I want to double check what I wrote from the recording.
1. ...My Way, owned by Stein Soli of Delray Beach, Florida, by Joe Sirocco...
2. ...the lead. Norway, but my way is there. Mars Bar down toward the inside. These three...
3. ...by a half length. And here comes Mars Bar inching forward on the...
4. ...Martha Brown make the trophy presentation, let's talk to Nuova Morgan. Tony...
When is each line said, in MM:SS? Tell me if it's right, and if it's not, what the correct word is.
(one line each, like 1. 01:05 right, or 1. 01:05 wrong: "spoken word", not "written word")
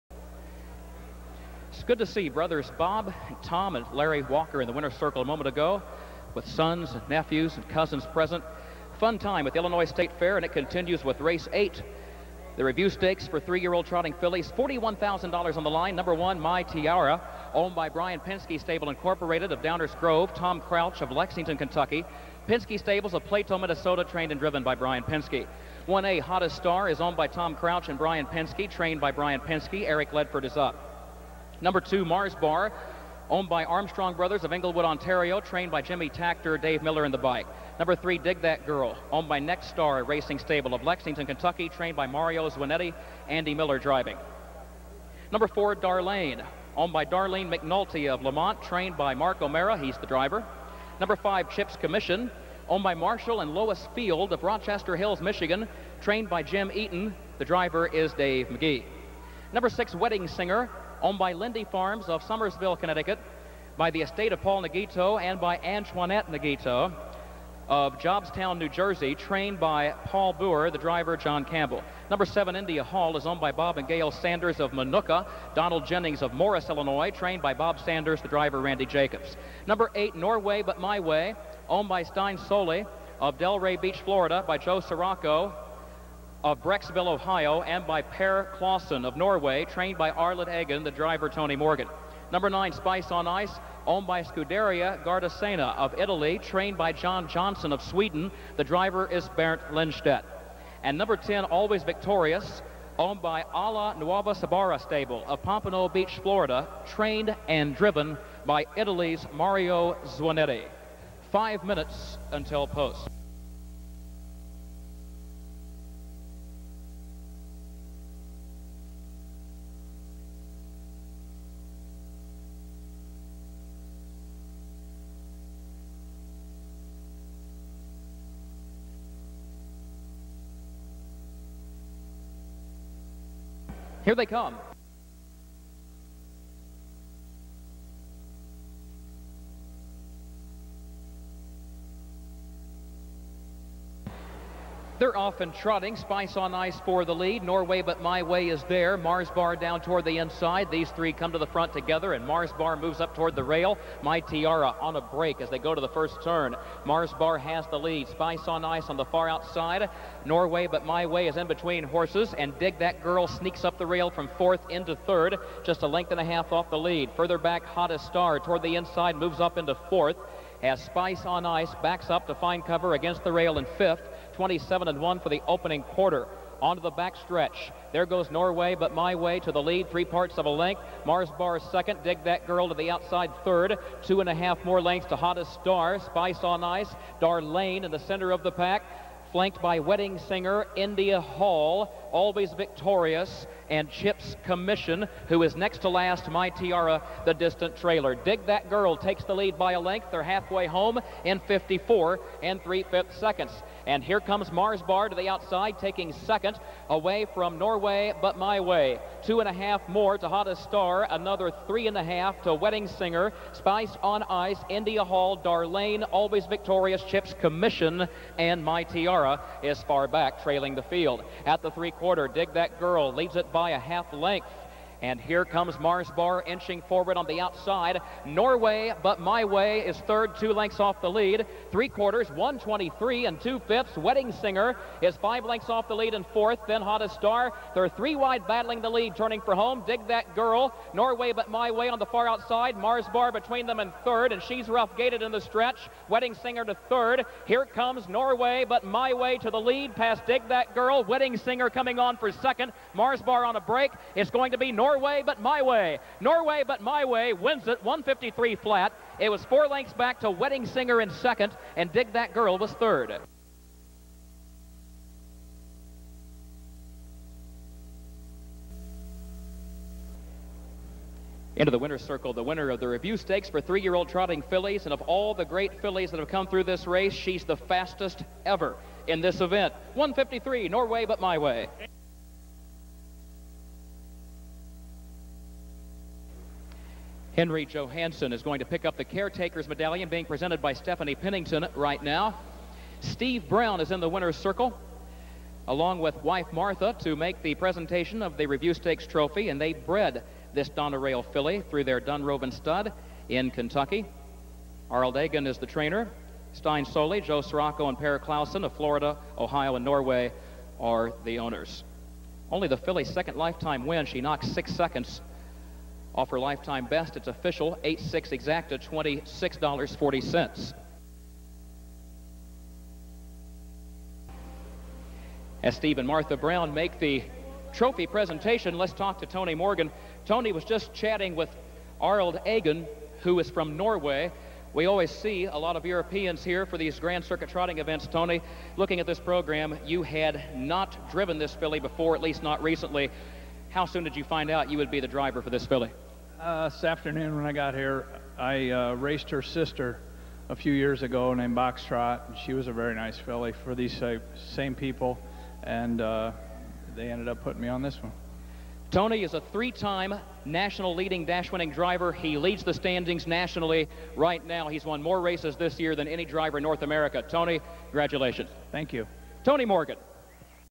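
1. 01:20 right
2. 02:27 right
3. 03:43 right
4. 05:26 wrong: "Tony", not "Nuova".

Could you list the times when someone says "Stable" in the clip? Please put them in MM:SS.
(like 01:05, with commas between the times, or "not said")
00:18, 00:22, 00:40, 01:44.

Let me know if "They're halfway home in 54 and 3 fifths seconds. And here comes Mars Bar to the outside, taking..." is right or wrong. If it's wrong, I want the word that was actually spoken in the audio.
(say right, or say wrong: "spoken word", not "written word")
right.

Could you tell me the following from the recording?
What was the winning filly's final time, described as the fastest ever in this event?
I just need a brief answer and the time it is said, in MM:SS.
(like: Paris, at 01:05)
1:53 flat, at 04:17.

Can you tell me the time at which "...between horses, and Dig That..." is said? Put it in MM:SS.
02:41.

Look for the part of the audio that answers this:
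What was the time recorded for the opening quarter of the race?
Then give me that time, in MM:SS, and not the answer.
02:54.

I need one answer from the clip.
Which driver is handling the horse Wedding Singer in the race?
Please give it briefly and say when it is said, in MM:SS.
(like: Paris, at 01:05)
John Campbell, at 01:11.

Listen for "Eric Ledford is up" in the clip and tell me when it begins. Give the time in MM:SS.
00:29.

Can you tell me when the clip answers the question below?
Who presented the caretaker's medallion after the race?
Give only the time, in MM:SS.
04:50.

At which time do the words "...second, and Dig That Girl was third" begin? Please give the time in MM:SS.
04:21.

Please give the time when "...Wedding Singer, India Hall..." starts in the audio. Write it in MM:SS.
03:09.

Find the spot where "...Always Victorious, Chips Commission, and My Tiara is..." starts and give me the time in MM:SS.
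03:36.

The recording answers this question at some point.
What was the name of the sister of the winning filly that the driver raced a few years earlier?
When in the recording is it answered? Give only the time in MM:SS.
05:51.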